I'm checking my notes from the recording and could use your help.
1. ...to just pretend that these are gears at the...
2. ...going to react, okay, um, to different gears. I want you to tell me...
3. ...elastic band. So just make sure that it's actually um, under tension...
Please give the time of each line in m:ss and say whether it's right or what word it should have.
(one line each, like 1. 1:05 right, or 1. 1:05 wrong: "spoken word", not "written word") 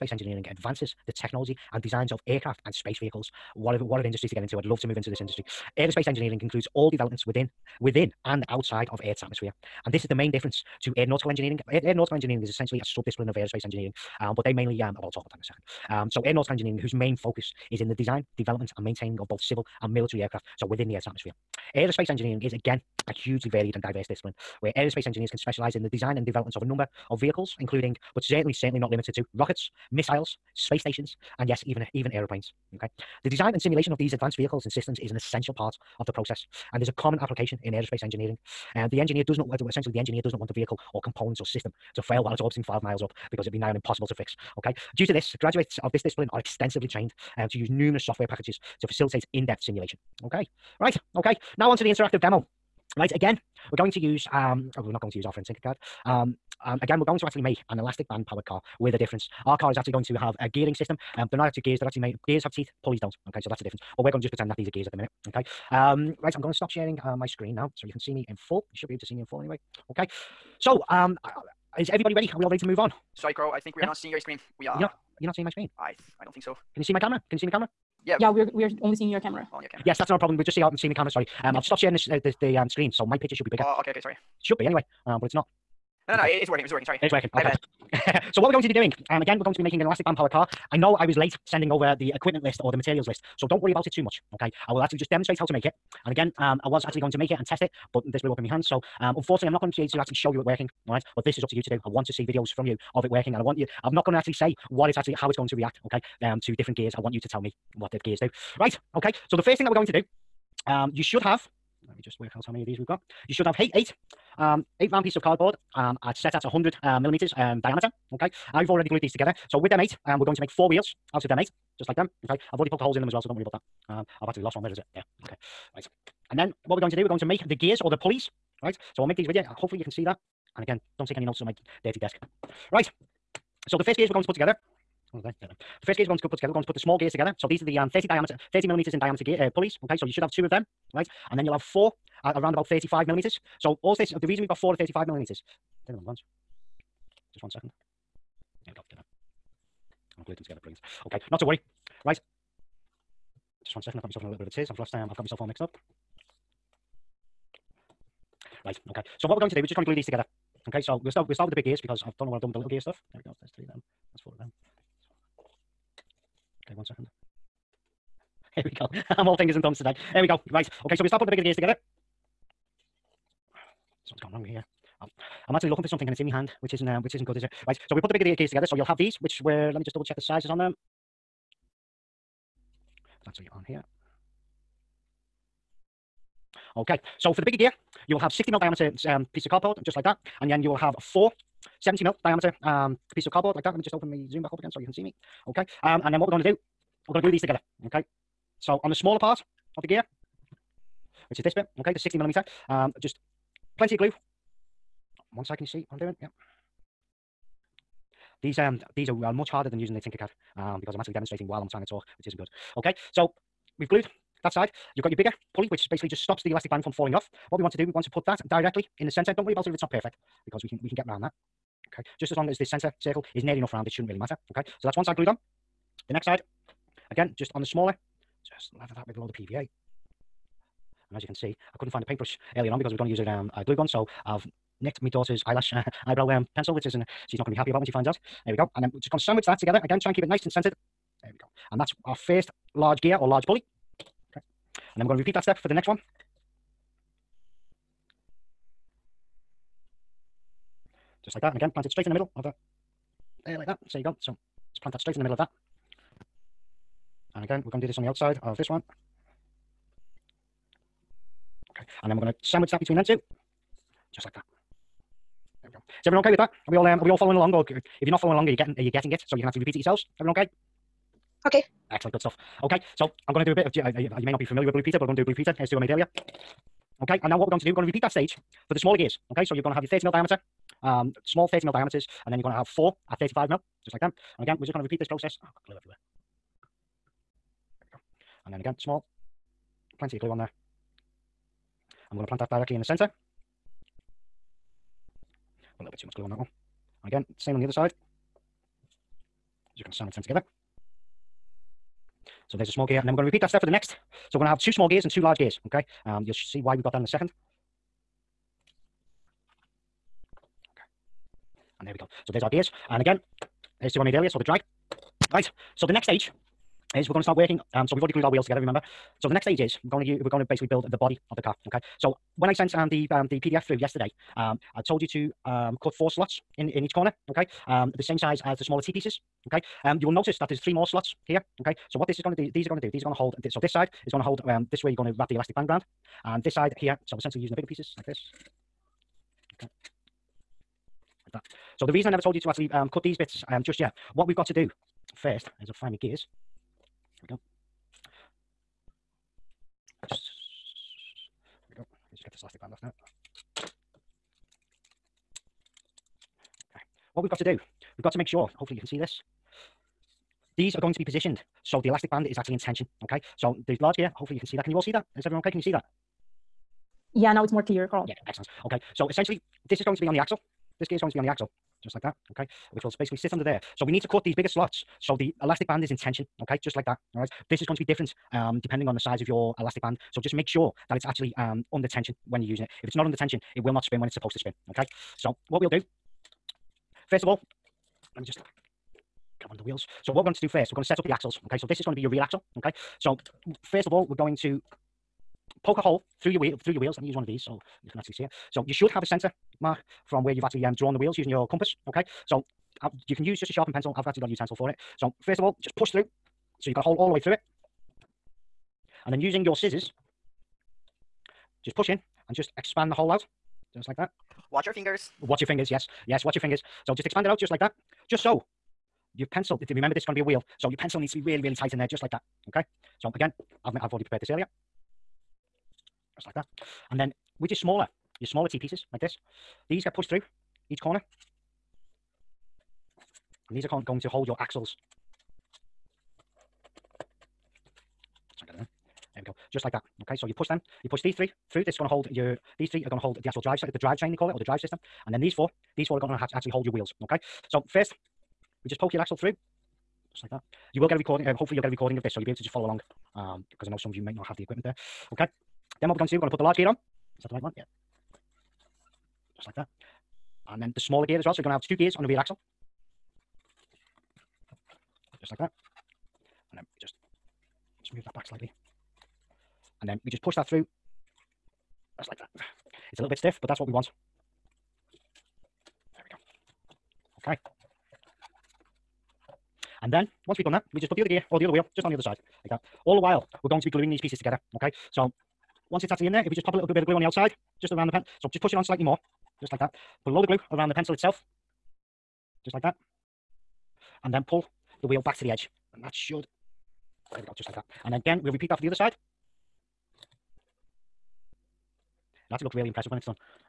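1. 1:04 right
2. 1:45 right
3. 6:19 right.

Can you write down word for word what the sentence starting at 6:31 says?
Okay, so this is going to be your rear axle.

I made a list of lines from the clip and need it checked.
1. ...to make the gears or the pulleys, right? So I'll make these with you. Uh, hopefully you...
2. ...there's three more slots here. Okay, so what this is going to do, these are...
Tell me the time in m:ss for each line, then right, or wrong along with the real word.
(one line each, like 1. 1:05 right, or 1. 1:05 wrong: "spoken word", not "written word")
1. 2:07 right
2. 5:30 right.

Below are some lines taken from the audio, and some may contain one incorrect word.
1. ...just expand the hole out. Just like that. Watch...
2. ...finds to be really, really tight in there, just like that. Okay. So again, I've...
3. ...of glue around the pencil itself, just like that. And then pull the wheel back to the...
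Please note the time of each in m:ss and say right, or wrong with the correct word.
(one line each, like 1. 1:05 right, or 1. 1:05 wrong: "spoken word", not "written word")
1. 6:52 right
2. 7:00 wrong: "needs", not "finds"
3. 8:10 right.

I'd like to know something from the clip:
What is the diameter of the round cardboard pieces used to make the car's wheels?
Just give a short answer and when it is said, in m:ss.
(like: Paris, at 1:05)
100 millimeters, at 1:56.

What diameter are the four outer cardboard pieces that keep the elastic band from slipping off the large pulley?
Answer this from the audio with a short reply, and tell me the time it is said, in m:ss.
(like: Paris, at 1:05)
70 mil, at 3:11.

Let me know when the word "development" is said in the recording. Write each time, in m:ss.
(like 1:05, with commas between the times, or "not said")
0:06, 0:18, 0:26.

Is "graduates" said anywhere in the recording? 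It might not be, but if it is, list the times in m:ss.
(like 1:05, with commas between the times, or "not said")
0:45.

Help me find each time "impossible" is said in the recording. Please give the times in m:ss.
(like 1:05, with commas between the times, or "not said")
0:43.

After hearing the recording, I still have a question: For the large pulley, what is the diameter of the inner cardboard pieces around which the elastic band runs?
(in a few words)
60 mil.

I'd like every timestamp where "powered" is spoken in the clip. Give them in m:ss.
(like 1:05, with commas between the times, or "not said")
0:58, 1:30.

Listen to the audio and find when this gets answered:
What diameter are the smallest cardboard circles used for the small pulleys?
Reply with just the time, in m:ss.
2:18.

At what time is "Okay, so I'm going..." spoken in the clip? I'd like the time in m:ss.
4:32.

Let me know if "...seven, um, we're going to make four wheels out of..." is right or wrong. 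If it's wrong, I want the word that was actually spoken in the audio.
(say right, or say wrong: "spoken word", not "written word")
wrong: "eight", not "seven".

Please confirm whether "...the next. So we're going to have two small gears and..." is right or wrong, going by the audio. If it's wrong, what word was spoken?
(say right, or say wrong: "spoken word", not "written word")
right.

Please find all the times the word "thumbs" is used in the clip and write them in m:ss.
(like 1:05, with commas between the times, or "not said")
2:49.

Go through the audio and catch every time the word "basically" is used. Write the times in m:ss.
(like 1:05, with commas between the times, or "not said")
3:35, 5:20, 6:12.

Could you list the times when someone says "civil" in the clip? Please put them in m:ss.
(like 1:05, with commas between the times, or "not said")
0:19.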